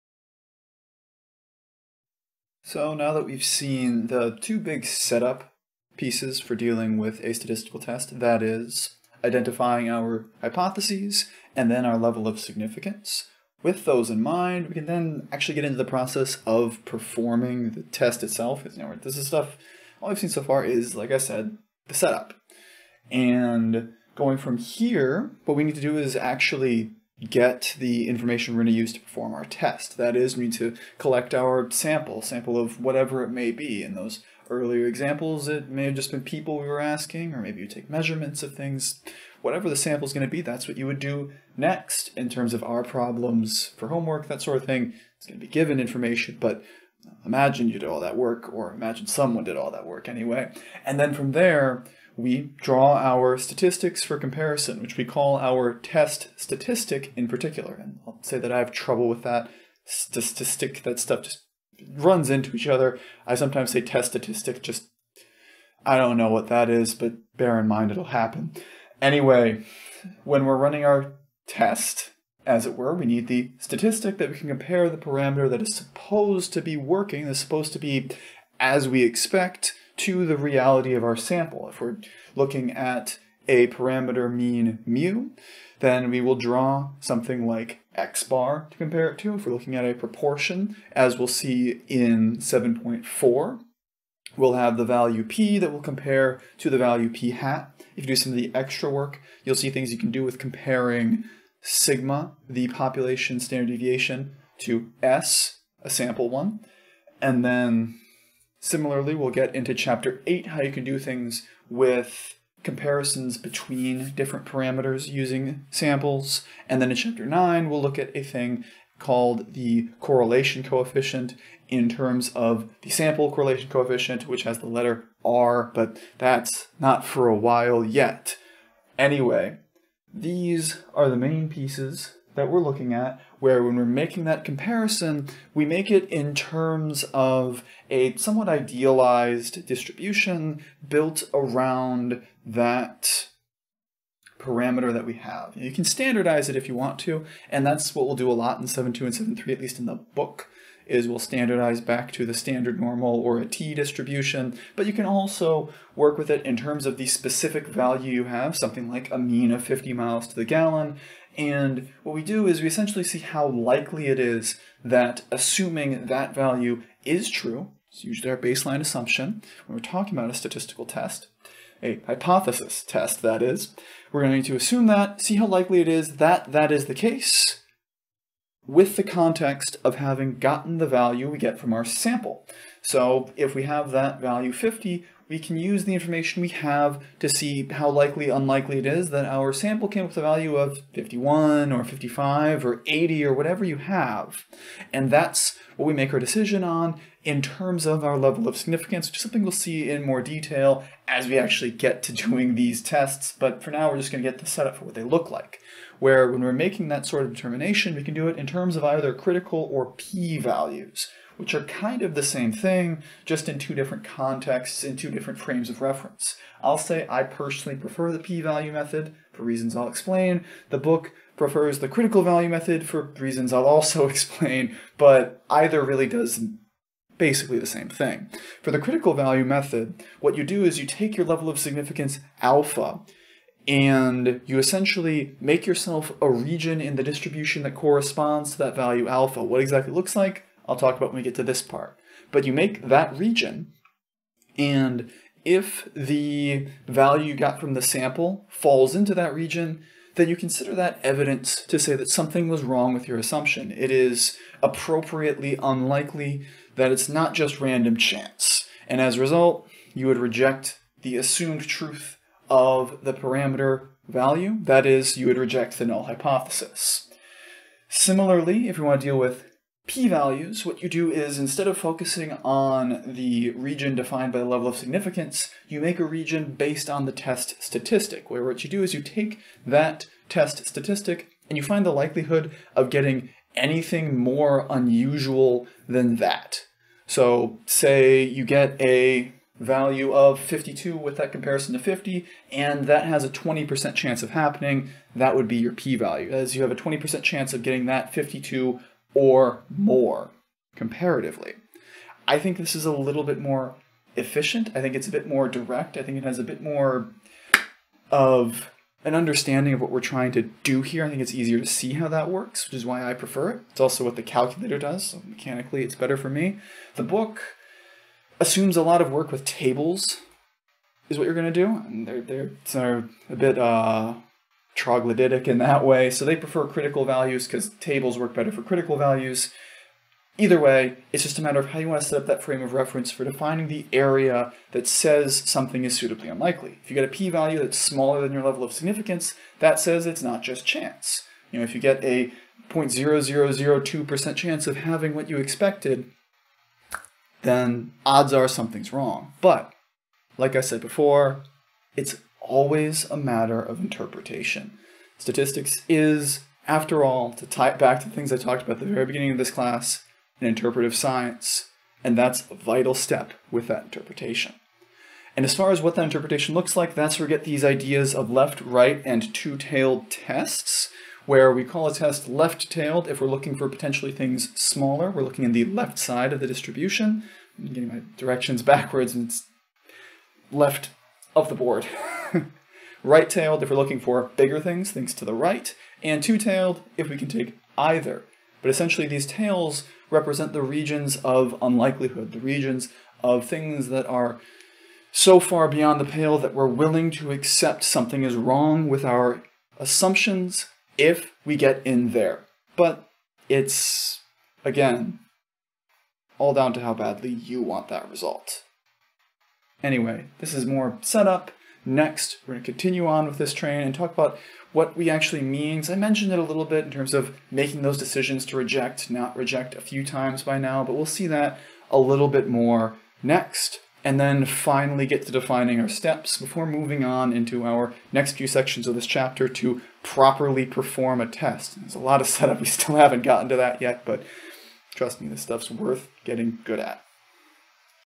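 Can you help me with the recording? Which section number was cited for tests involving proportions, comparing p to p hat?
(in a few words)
7.4.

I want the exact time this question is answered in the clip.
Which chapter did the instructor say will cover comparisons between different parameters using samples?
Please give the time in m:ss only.
1:49.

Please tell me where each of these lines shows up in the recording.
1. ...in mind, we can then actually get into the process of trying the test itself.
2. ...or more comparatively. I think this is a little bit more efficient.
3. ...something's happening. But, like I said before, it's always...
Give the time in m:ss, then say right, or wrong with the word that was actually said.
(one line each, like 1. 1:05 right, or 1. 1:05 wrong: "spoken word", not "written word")
1. 0:14 wrong: "performing", not "trying"
2. 4:59 right
3. 5:48 wrong: "wrong", not "happening".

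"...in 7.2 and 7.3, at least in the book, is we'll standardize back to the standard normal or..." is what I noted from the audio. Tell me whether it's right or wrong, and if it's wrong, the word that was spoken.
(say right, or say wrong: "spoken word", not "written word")
right.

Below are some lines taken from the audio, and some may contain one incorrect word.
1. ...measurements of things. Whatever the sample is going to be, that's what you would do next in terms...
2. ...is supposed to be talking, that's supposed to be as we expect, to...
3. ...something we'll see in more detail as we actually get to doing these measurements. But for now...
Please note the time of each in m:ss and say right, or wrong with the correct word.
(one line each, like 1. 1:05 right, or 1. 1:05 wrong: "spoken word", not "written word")
1. 0:37 right
2. 1:15 wrong: "working", not "talking"
3. 3:19 wrong: "tests", not "measurements".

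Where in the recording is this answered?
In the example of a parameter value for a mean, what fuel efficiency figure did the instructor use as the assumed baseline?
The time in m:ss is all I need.
2:39.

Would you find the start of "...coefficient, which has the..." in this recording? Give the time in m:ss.
2:03.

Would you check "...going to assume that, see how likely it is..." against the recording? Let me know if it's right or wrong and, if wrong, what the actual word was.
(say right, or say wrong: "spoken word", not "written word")
right.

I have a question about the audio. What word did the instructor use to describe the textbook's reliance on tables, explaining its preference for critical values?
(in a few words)
troglodytic.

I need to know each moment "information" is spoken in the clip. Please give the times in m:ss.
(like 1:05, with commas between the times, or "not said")
0:28, 0:45, 3:05.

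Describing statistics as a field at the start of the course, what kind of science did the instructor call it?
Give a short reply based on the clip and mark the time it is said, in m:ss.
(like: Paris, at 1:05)
an interpretive science, at 6:00.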